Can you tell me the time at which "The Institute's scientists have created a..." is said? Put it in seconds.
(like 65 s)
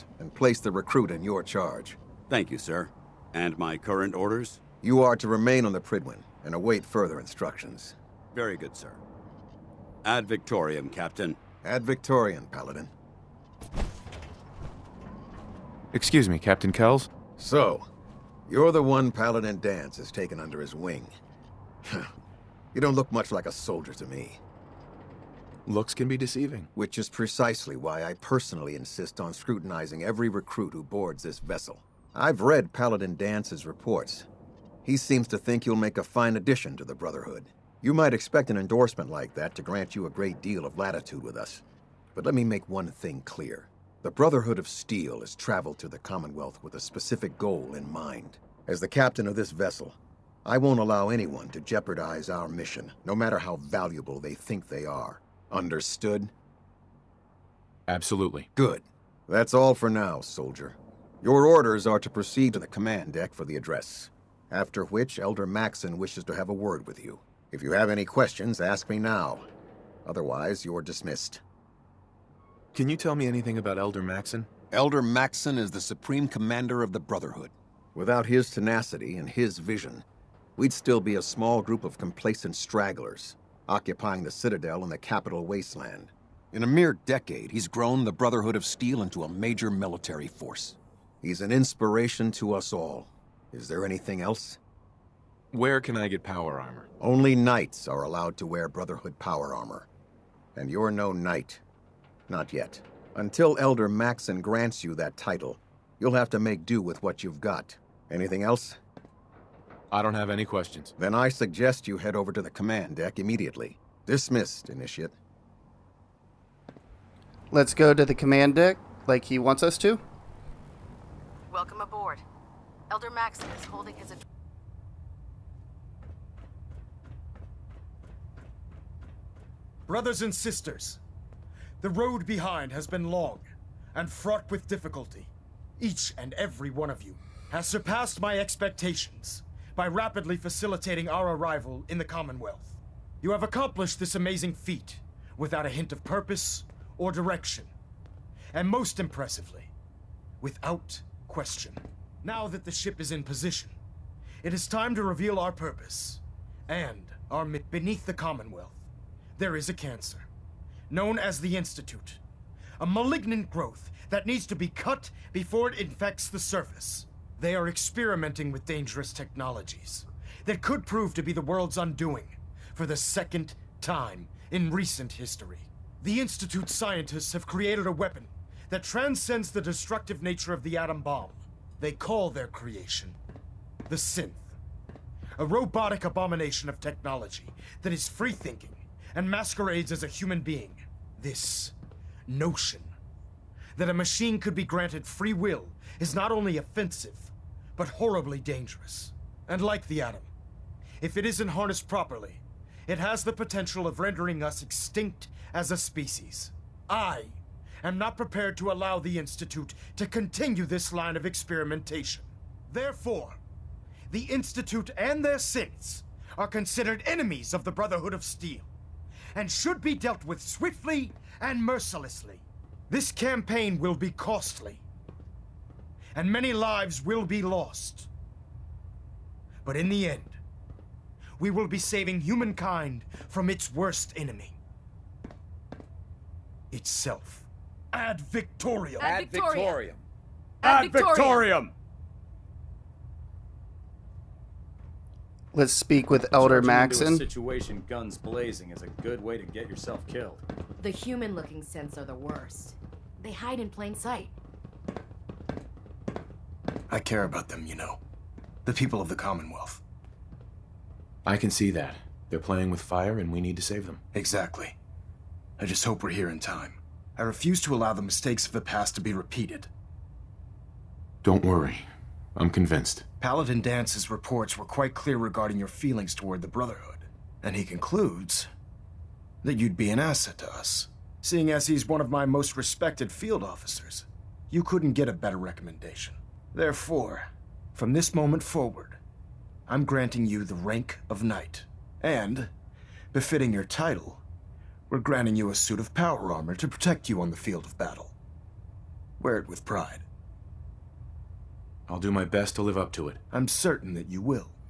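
176 s.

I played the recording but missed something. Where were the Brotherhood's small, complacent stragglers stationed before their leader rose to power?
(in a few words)
The Citadel.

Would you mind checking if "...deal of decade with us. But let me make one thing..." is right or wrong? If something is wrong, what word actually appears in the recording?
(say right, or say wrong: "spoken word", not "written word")
wrong: "latitude", not "decade".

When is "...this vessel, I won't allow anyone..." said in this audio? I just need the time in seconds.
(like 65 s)
49 s.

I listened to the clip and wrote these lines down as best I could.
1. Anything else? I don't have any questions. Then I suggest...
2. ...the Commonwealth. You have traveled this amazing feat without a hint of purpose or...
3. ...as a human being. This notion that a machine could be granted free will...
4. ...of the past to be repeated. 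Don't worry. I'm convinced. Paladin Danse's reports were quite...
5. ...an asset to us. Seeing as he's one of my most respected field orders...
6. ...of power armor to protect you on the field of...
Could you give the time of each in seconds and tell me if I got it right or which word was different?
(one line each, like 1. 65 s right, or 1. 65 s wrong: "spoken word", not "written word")
1. 108 s right
2. 141 s wrong: "accomplished", not "traveled"
3. 189 s right
4. 268 s right
5. 279 s wrong: "officers", not "orders"
6. 295 s right.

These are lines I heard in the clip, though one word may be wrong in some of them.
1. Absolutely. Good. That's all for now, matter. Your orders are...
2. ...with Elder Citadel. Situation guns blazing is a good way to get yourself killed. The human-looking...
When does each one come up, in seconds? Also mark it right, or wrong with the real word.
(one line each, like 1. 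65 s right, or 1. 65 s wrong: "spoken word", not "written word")
1. 57 s wrong: "soldier", not "matter"
2. 246 s wrong: "Maxson", not "Citadel".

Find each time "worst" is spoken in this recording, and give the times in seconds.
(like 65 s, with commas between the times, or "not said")
233 s, 252 s.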